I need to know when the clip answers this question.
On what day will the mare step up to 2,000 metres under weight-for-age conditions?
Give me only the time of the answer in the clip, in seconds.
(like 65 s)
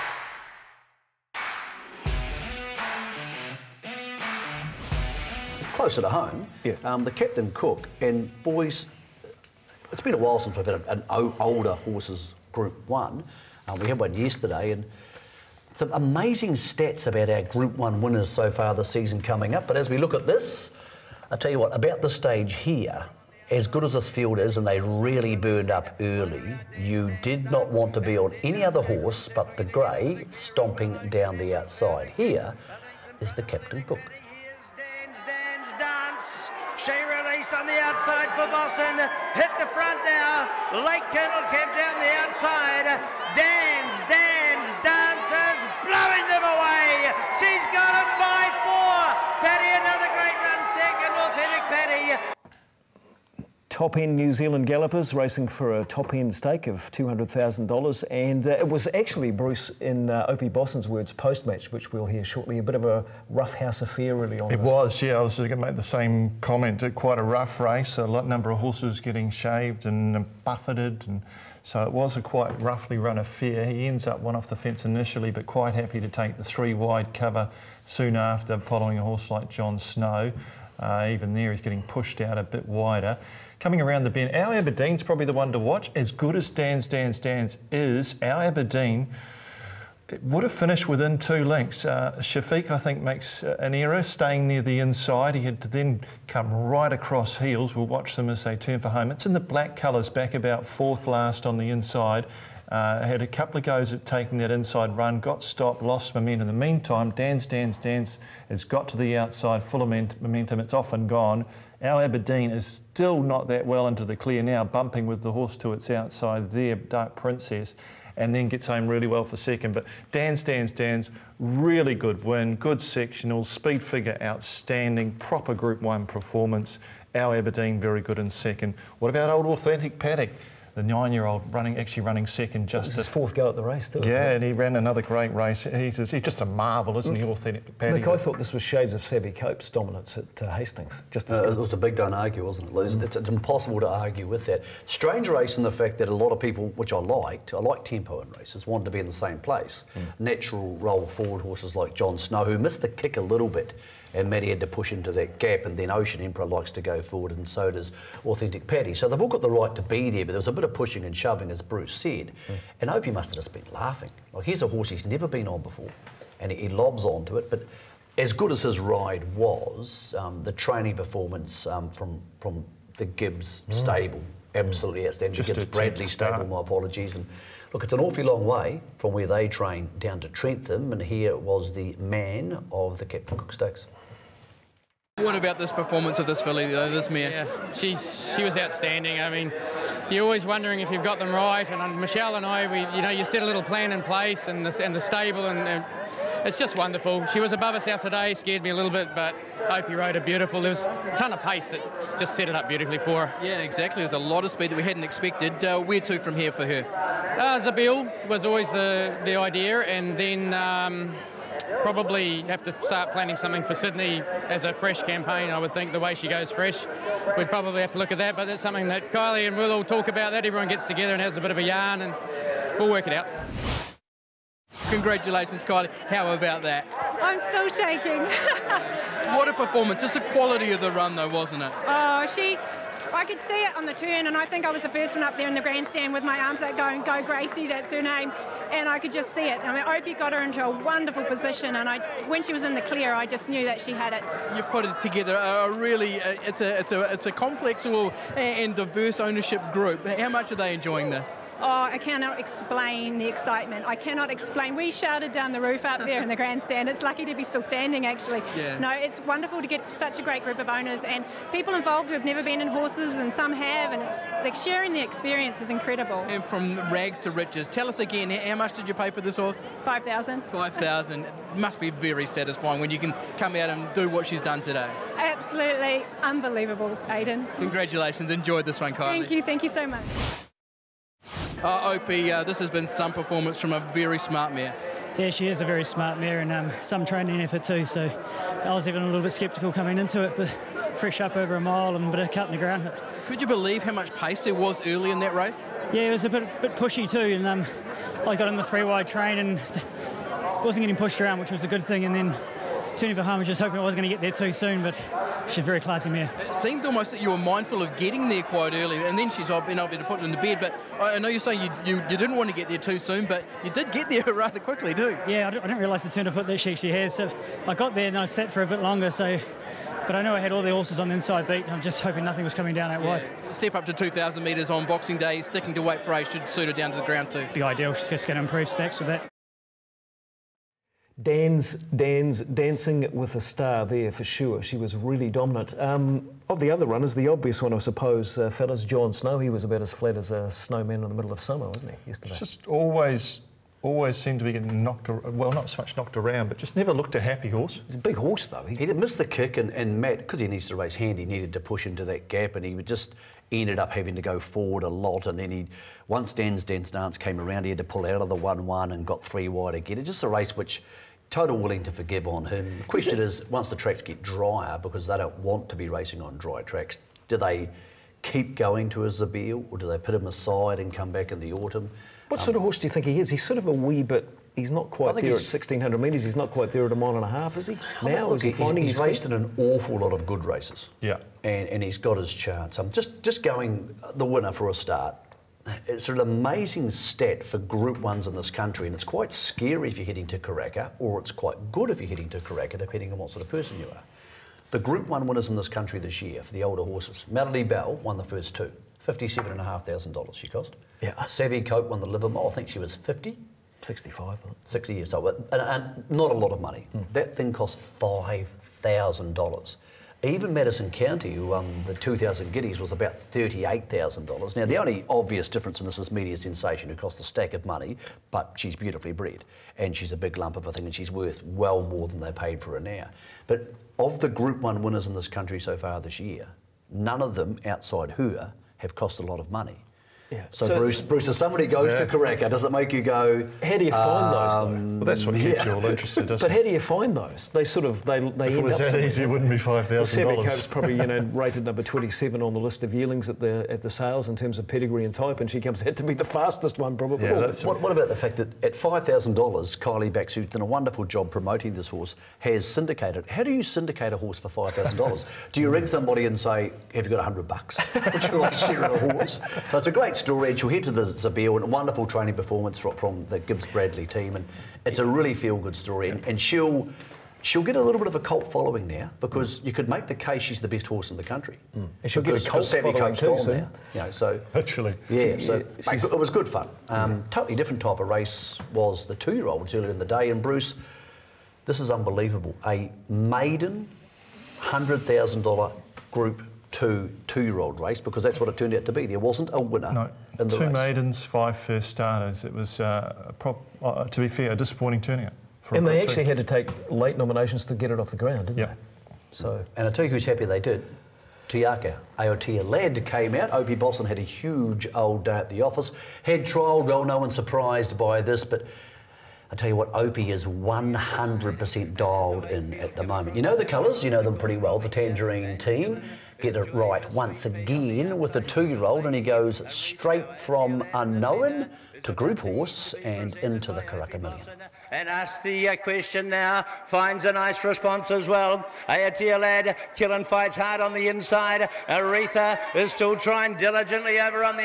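324 s.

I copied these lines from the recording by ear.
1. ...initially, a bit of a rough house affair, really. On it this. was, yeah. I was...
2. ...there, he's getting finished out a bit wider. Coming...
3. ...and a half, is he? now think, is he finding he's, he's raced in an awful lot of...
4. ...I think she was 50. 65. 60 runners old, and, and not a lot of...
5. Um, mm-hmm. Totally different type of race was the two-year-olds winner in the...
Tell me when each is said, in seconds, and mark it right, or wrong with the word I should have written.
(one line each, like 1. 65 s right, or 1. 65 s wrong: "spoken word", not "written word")
1. 62 s wrong: "shortly", not "initially"
2. 81 s wrong: "pushed", not "finished"
3. 377 s right
4. 402 s wrong: "years", not "runners"
5. 476 s wrong: "earlier", not "winner".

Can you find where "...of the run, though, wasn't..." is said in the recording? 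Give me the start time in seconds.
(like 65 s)
230 s.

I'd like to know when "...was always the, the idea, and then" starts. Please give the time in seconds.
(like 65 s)
208 s.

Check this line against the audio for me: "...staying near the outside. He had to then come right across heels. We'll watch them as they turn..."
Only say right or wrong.
wrong.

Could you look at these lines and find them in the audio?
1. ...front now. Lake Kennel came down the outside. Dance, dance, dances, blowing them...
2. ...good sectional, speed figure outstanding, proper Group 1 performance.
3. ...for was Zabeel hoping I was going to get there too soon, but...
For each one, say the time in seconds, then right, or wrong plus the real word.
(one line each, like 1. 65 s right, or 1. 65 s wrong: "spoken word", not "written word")
1. 39 s right
2. 122 s right
3. 303 s wrong: "Just", not "Zabeel".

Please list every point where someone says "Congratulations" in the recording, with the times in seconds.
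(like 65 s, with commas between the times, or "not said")
224 s, 277 s.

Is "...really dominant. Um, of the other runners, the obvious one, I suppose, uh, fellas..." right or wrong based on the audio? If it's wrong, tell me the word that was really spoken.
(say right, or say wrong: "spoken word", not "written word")
right.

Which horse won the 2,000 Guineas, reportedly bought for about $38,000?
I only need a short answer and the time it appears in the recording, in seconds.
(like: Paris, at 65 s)
Madison County, at 410 s.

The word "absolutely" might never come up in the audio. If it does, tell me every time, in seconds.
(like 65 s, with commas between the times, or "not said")
174 s, 275 s.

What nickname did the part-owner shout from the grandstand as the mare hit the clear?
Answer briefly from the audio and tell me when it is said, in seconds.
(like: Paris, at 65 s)
Gracie, at 237 s.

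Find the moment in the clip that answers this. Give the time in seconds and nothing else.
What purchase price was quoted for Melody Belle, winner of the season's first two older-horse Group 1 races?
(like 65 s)
399 s.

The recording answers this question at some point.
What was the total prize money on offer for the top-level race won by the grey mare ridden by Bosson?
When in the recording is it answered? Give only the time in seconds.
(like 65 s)
56 s.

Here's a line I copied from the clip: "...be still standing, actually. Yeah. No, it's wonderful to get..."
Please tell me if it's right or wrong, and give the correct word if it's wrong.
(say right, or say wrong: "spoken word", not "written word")
right.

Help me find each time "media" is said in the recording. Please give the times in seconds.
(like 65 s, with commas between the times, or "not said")
416 s.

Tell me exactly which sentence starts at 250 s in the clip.
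How much are they enjoying this?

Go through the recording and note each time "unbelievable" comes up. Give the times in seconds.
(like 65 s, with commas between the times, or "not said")
276 s, 481 s.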